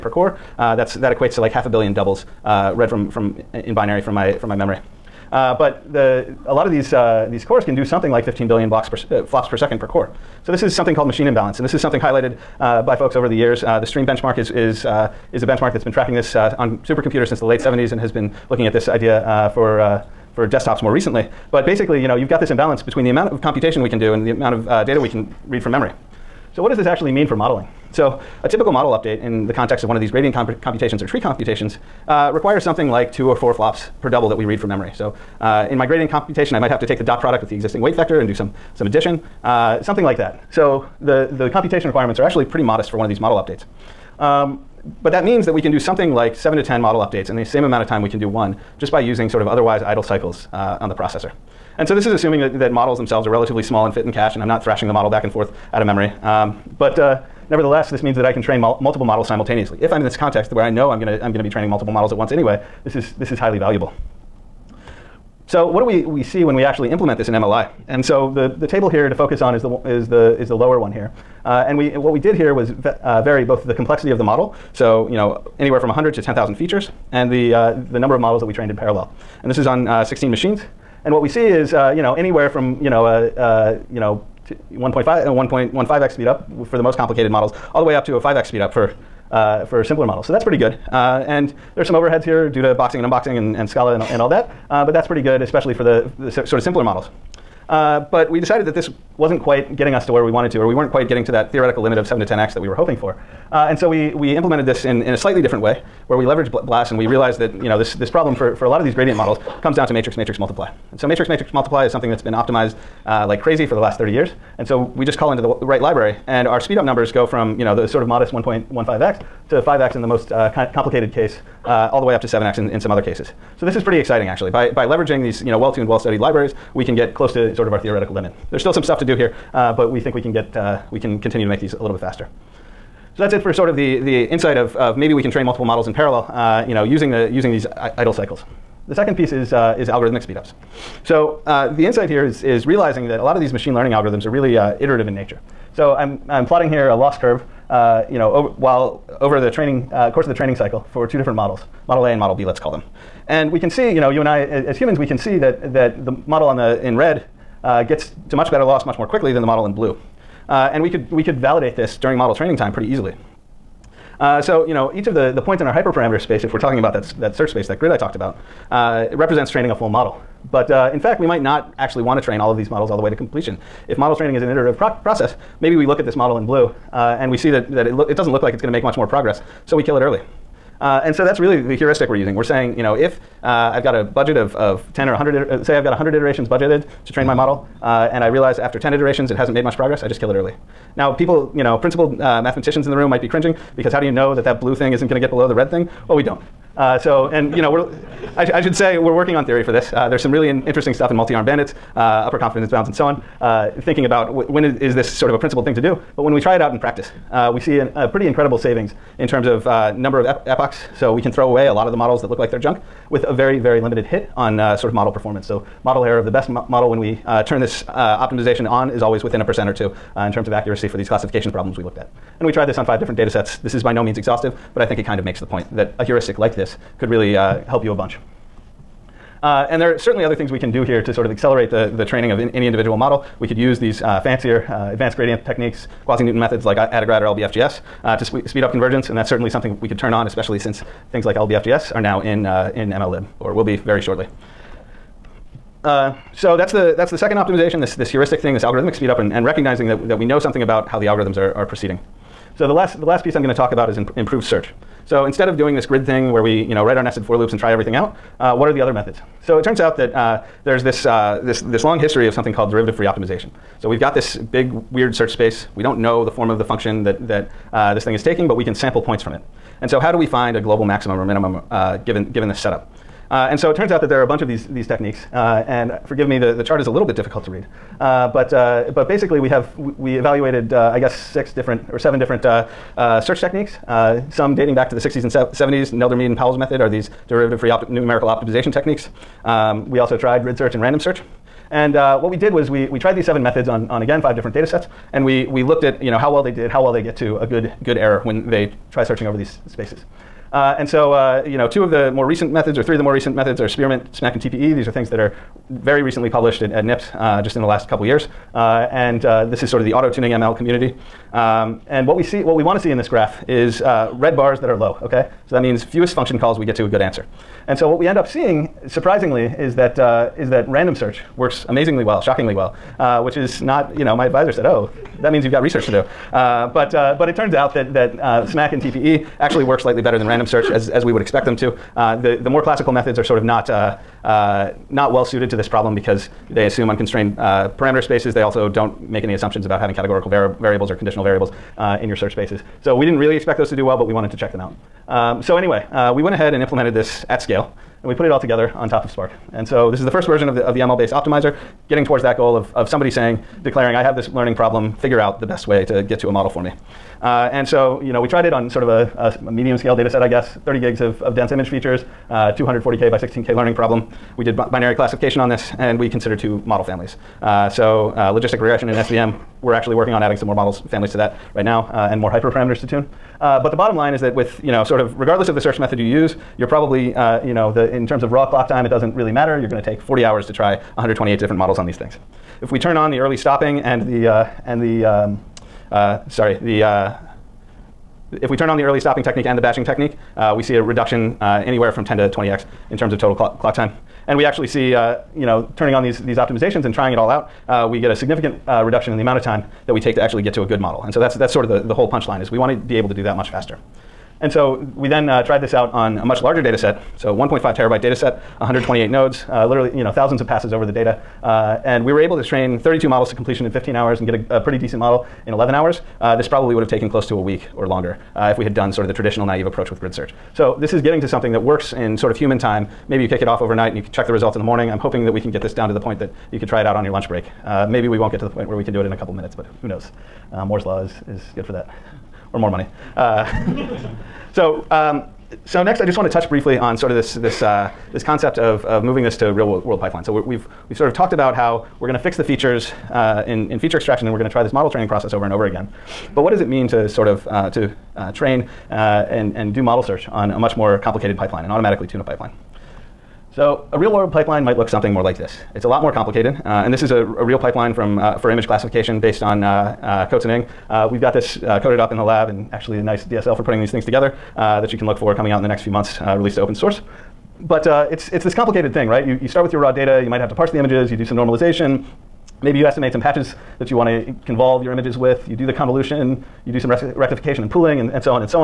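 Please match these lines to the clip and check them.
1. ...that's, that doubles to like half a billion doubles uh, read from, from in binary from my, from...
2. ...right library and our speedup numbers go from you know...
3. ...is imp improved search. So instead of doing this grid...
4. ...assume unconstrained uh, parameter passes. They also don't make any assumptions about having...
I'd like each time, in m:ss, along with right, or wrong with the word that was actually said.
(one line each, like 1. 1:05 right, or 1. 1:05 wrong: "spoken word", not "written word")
1. 0:00 wrong: "equates", not "doubles"
2. 1:55 right
3. 4:13 right
4. 5:36 wrong: "spaces", not "passes".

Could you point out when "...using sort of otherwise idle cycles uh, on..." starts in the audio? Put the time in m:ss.
0:48.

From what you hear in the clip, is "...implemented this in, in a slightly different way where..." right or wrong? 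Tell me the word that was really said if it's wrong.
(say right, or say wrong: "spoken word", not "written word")
right.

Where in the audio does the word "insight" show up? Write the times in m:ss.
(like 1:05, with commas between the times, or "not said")
2:14, 2:21.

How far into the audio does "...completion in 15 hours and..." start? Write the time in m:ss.
6:53.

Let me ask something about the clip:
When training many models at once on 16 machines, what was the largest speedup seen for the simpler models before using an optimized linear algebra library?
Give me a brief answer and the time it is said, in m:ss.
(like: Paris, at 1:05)
5x, at 1:28.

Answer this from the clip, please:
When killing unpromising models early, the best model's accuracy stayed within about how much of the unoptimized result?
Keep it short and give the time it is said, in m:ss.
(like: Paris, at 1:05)
a percent or two, at 3:39.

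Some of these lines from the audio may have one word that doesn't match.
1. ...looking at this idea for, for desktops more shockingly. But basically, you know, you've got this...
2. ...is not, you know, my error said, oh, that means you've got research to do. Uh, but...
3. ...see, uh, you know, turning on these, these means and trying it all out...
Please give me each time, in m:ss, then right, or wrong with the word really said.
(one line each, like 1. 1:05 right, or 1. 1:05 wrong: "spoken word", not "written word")
1. 0:18 wrong: "recently", not "shockingly"
2. 5:23 wrong: "advisor", not "error"
3. 6:34 wrong: "optimizations", not "means".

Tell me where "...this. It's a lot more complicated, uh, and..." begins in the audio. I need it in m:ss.
7:35.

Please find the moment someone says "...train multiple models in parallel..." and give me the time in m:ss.
2:15.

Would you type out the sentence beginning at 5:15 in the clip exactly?
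So that means fewest function calls we get to a good answer.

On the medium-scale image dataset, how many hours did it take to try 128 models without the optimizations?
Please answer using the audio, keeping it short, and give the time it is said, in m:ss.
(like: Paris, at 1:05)
40 hours, at 6:19.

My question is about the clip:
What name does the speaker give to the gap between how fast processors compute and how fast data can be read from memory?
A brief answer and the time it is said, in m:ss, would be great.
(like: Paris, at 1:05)
machine imbalance, at 0:11.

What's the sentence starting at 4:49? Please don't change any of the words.
Um, we also tried grid search and random search.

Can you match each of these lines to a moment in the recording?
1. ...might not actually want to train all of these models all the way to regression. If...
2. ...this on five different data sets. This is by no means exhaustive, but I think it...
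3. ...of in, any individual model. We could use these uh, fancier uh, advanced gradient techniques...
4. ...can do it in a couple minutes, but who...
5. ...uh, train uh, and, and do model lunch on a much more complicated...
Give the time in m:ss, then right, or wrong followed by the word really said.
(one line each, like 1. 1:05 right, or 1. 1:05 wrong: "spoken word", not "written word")
1. 2:51 wrong: "completion", not "regression"
2. 3:42 right
3. 3:52 right
4. 7:08 right
5. 7:28 wrong: "search", not "lunch".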